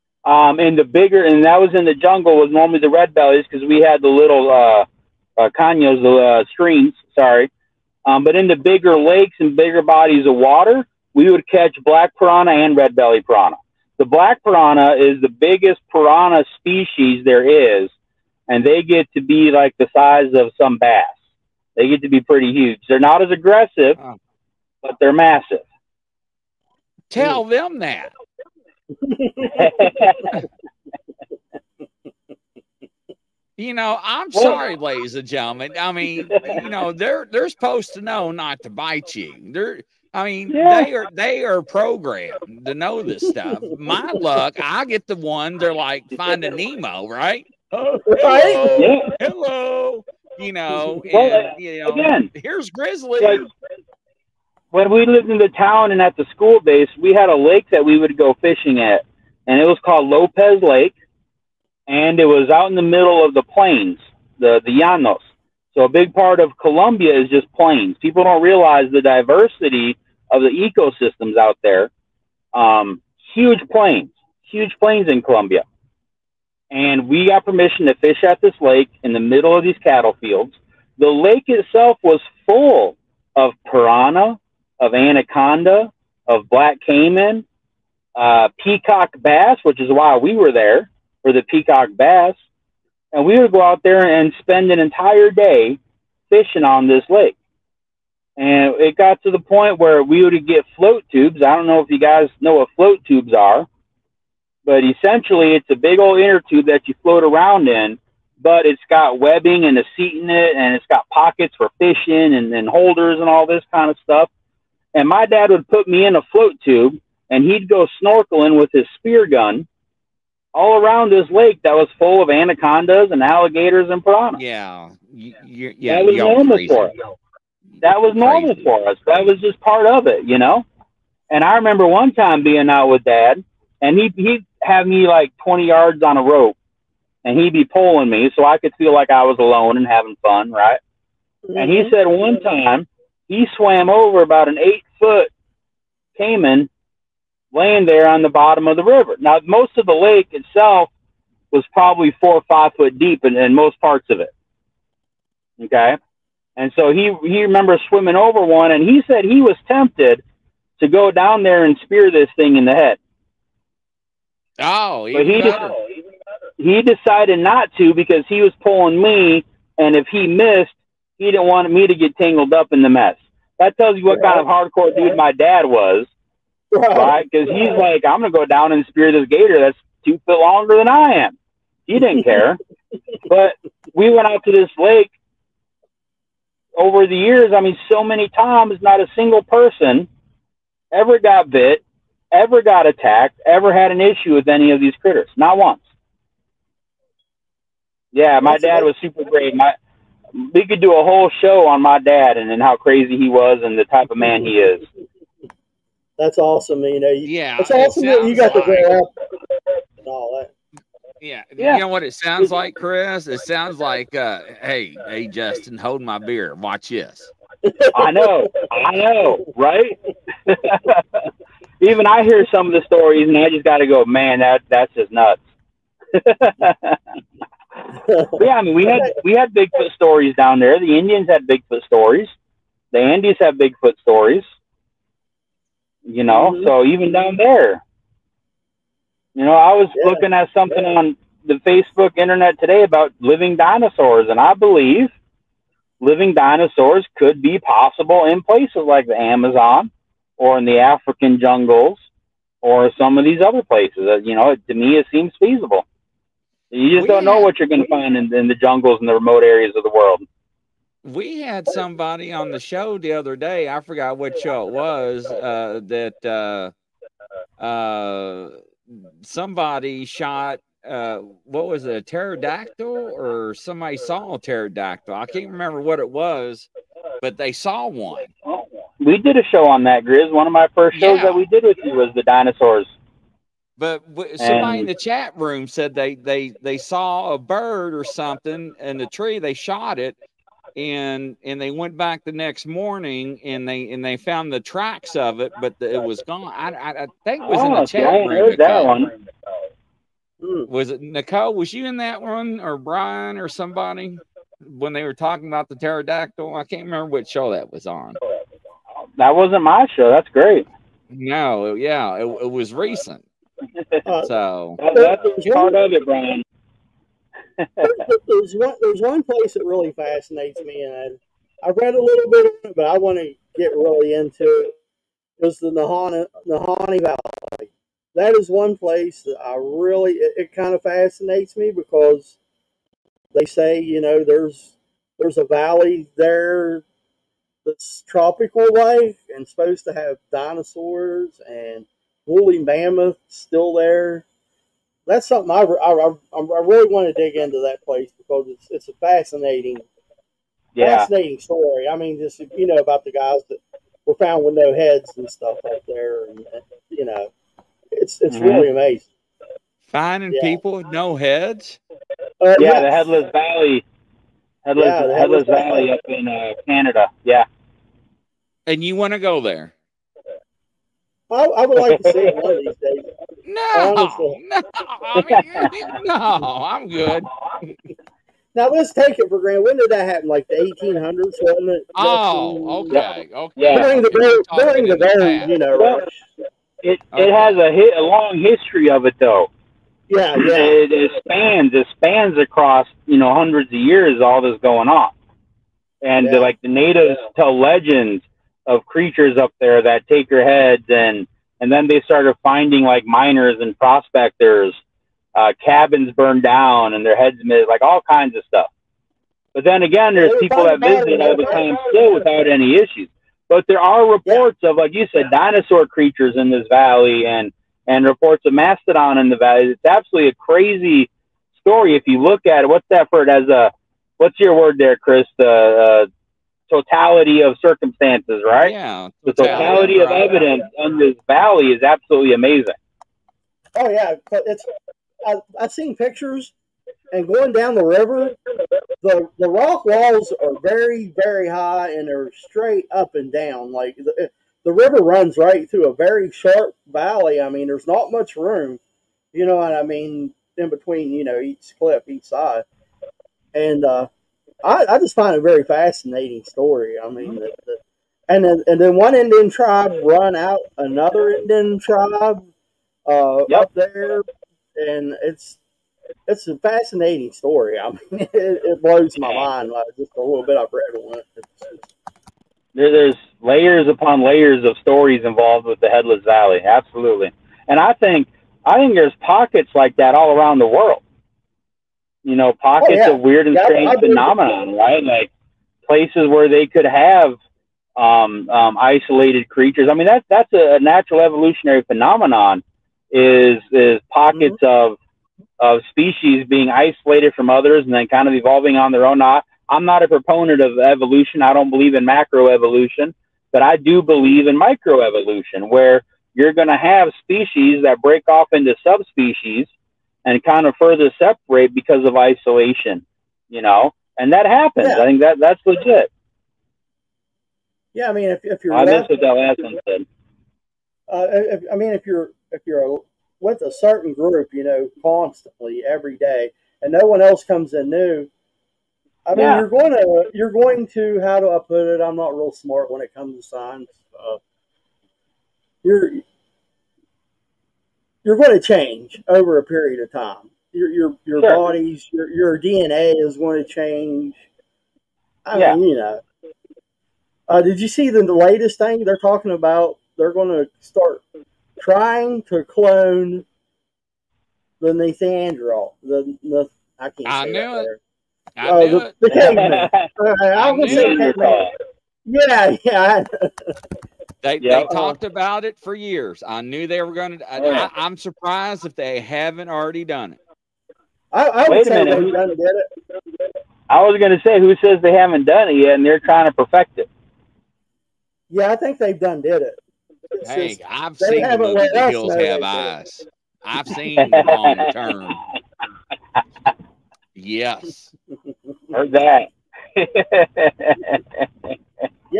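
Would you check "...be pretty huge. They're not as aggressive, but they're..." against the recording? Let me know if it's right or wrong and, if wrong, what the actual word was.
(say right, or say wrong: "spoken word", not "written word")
right.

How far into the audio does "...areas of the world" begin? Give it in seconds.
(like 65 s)
259 s.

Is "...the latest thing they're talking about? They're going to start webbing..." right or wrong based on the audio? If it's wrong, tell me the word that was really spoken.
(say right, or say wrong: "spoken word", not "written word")
wrong: "trying", not "webbing".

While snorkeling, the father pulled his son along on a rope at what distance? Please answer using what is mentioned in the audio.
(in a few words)
20 yards.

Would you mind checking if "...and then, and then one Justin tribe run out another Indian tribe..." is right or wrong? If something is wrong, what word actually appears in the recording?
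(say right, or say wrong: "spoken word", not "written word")
wrong: "Indian", not "Justin".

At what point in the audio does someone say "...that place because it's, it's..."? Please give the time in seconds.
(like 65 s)
347 s.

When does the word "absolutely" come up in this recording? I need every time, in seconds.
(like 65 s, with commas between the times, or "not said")
419 s, 431 s, 476 s.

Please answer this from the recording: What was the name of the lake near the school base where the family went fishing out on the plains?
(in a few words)
Lopez Lake.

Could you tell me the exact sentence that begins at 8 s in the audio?
Um, but in the bigger lakes and bigger bodies of water, we would catch black piranha and red belly piranha.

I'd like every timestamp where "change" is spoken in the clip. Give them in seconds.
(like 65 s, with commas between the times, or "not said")
538 s, 543 s.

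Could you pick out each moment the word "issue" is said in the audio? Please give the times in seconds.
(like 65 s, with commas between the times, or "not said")
194 s, 412 s.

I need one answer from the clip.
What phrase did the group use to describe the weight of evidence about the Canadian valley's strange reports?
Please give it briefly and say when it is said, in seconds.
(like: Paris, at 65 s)
Totality of circumstances, at 426 s.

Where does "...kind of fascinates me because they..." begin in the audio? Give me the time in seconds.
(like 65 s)
330 s.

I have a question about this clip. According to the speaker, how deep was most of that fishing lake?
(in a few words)
4 or 5 feet.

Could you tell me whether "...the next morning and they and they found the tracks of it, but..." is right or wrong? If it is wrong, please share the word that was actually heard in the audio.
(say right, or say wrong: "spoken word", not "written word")
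right.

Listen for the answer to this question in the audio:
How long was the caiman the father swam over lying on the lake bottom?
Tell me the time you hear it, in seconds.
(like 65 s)
144 s.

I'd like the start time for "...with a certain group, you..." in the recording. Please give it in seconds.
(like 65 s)
523 s.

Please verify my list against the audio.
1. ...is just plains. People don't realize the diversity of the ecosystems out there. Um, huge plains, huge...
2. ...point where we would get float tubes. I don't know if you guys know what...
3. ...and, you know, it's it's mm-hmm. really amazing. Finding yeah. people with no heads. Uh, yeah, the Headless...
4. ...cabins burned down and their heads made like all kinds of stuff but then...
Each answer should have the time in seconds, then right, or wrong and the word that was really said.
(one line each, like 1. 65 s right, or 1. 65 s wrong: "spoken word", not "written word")
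1. 67 s right
2. 99 s right
3. 356 s right
4. 405 s right.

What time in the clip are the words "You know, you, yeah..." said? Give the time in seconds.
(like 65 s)
206 s.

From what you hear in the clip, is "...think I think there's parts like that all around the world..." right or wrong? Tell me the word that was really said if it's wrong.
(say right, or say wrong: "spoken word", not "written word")
wrong: "pockets", not "parts".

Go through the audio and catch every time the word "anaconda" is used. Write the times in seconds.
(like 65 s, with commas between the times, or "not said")
84 s, 122 s.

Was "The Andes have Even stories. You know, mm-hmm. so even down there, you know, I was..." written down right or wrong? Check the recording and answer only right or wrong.
wrong.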